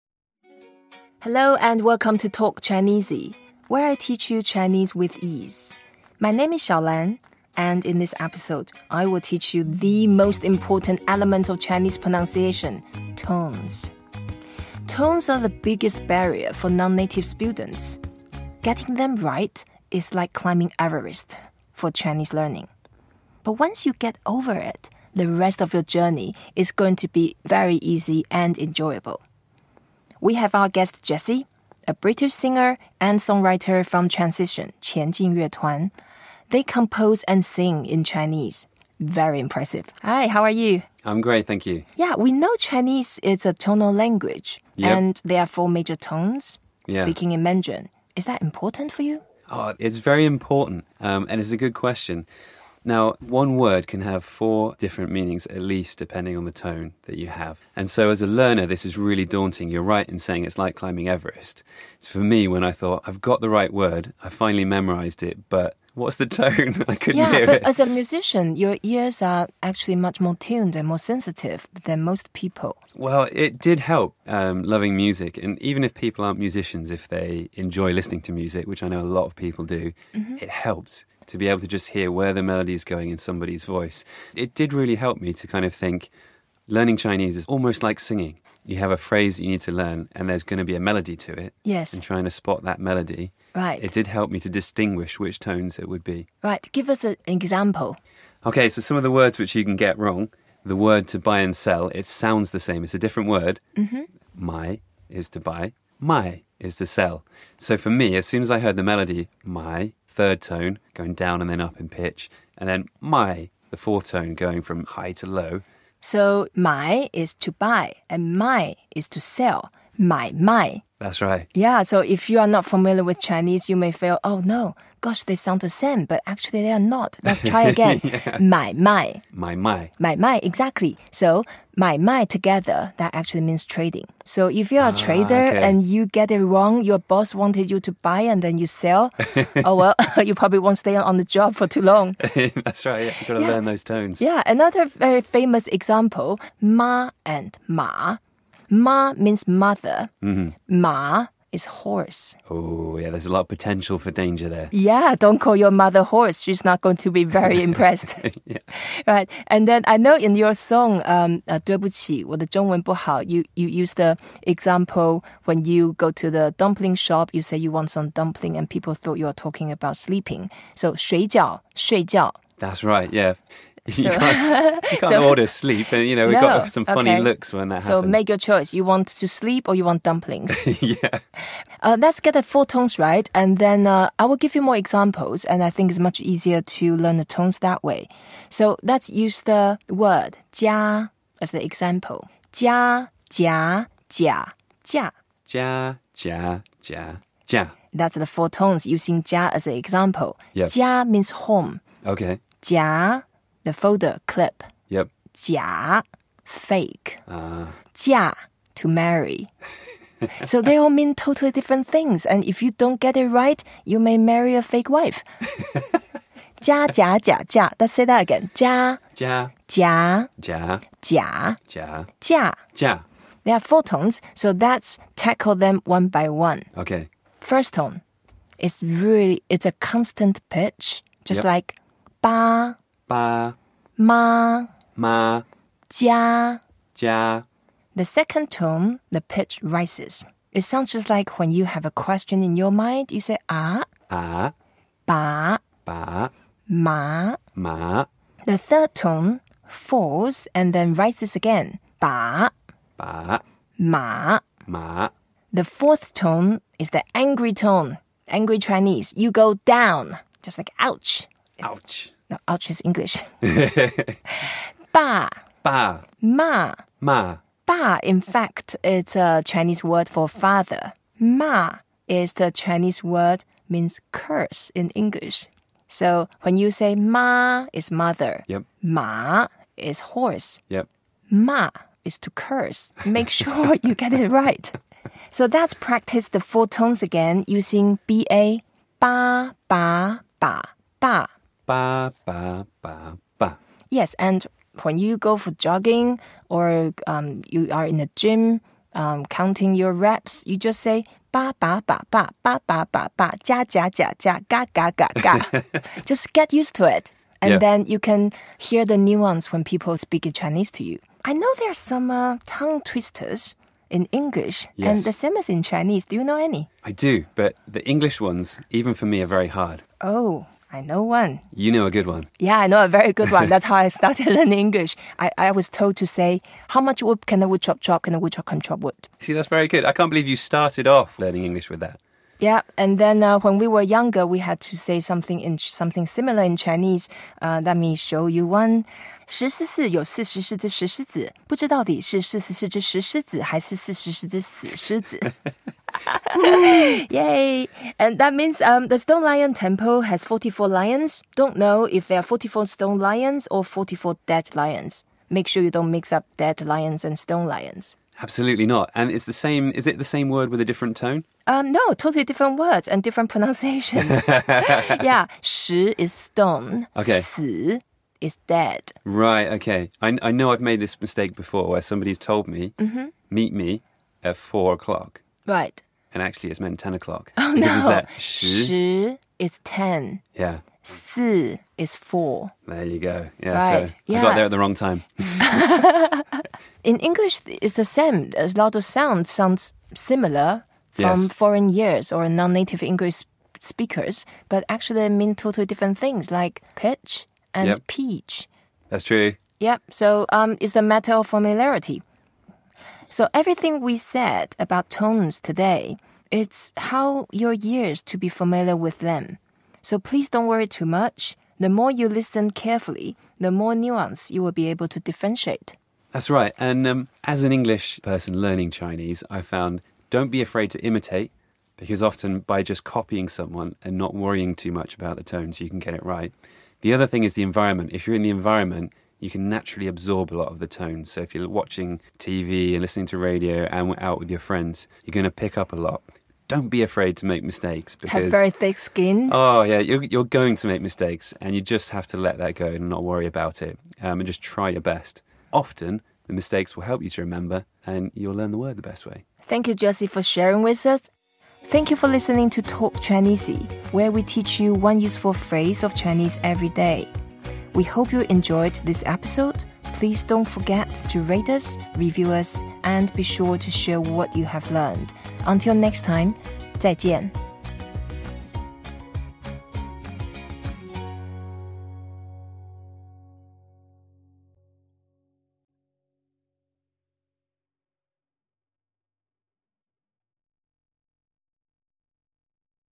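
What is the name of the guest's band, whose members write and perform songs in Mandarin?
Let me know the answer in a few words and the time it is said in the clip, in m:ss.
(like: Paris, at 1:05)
Transition, at 0:34.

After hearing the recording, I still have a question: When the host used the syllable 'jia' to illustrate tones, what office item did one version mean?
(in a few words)
folder clip.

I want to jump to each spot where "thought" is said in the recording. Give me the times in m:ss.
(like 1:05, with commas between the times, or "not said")
1:02, 2:48.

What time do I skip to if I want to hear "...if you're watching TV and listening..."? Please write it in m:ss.
7:11.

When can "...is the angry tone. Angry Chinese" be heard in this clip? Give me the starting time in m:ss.
4:16.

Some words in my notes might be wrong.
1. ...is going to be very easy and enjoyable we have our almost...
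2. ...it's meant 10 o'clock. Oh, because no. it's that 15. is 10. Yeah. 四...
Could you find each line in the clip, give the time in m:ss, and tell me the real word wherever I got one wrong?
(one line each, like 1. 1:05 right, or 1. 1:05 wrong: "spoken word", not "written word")
1. 0:26 wrong: "guest", not "almost"
2. 6:16 wrong: "10", not "15".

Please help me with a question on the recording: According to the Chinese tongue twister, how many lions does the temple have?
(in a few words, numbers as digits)
44.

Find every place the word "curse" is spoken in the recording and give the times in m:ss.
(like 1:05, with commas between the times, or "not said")
4:34, 4:42.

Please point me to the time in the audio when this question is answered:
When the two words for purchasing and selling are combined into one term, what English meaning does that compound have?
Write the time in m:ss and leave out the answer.
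2:13.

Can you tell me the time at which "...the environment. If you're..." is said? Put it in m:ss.
7:07.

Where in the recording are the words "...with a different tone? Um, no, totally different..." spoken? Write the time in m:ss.
6:00.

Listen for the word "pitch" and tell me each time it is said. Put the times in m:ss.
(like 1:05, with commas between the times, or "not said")
1:51, 3:50, 3:59, 6:36.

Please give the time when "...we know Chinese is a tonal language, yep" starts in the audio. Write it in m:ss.
0:42.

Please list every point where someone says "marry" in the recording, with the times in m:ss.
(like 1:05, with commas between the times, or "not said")
3:28, 3:34.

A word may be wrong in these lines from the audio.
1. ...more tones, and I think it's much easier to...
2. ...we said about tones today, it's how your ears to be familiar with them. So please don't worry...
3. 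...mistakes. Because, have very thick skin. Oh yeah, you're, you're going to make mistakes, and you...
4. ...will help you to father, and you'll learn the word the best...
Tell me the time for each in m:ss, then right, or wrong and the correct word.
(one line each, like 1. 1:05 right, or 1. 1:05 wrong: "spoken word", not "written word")
1. 3:04 wrong: "examples", not "tones"
2. 6:43 right
3. 7:17 right
4. 7:26 wrong: "remember", not "father".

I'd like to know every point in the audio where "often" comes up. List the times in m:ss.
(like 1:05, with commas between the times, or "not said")
7:02, 7:25.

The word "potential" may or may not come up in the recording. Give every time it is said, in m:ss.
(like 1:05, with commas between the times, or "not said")
2:33.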